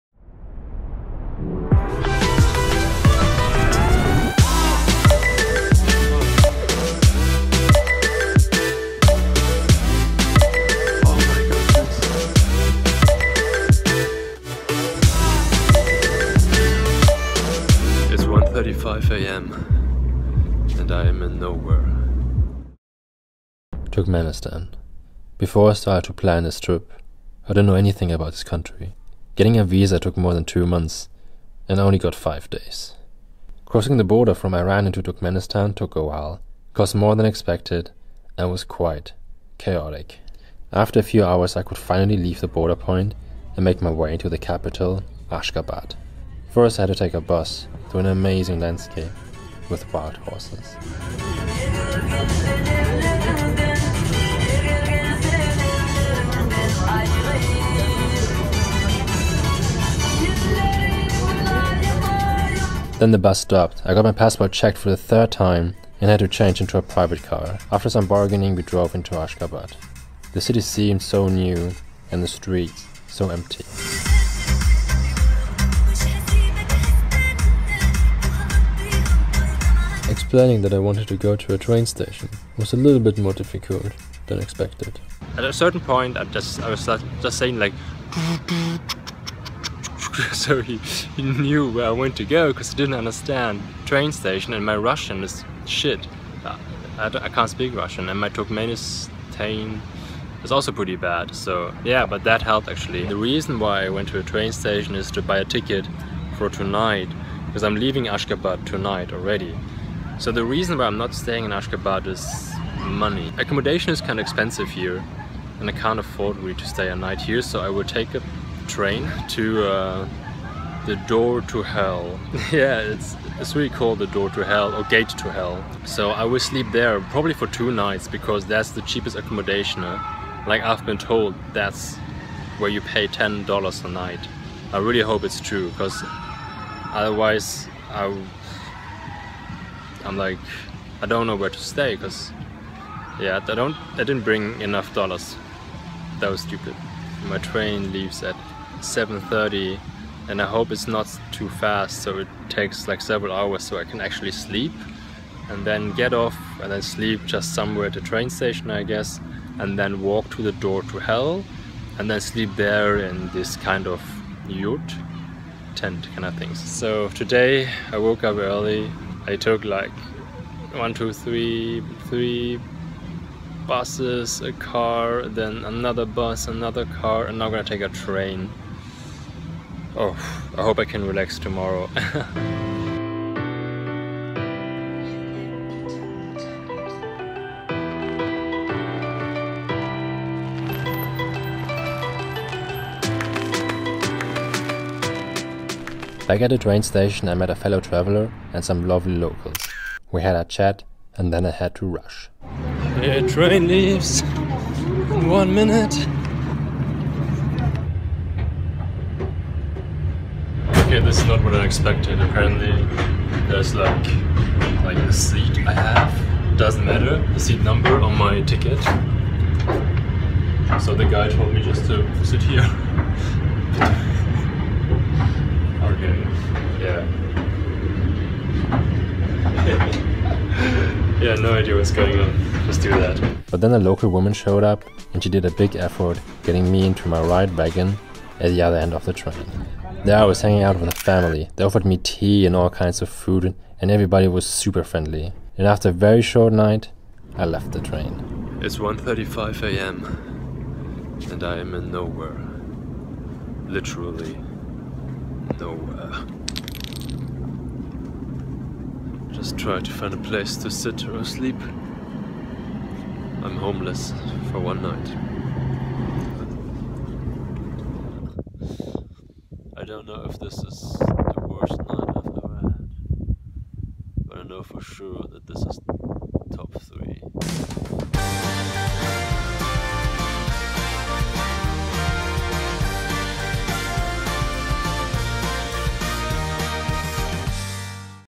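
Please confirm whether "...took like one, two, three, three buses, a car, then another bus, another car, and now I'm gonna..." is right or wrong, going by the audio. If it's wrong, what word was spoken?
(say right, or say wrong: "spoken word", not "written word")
right.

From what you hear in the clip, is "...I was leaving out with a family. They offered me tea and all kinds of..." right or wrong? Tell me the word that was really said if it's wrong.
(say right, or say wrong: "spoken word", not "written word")
wrong: "hanging", not "leaving".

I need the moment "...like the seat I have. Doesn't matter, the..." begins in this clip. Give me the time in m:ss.
3:34.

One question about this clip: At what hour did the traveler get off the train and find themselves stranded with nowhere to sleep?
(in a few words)
1:35 a.m.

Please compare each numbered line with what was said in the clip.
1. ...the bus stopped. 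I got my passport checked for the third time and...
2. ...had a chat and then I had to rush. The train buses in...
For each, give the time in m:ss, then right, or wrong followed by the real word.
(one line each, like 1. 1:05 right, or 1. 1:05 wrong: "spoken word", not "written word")
1. 1:03 right
2. 3:20 wrong: "leaves", not "buses".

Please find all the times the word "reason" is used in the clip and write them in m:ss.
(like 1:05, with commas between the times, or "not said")
1:43, 1:50.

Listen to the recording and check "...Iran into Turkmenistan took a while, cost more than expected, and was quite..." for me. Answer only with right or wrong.
right.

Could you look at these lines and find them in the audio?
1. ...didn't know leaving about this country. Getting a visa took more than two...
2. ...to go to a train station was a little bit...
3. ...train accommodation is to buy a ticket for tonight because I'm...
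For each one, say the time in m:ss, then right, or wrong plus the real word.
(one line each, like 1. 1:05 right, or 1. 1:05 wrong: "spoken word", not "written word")
1. 0:27 wrong: "anything", not "leaving"
2. 1:21 right
3. 1:44 wrong: "station", not "accommodation".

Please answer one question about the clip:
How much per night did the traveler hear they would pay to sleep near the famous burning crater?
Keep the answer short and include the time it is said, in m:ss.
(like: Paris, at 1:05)
$10, at 2:13.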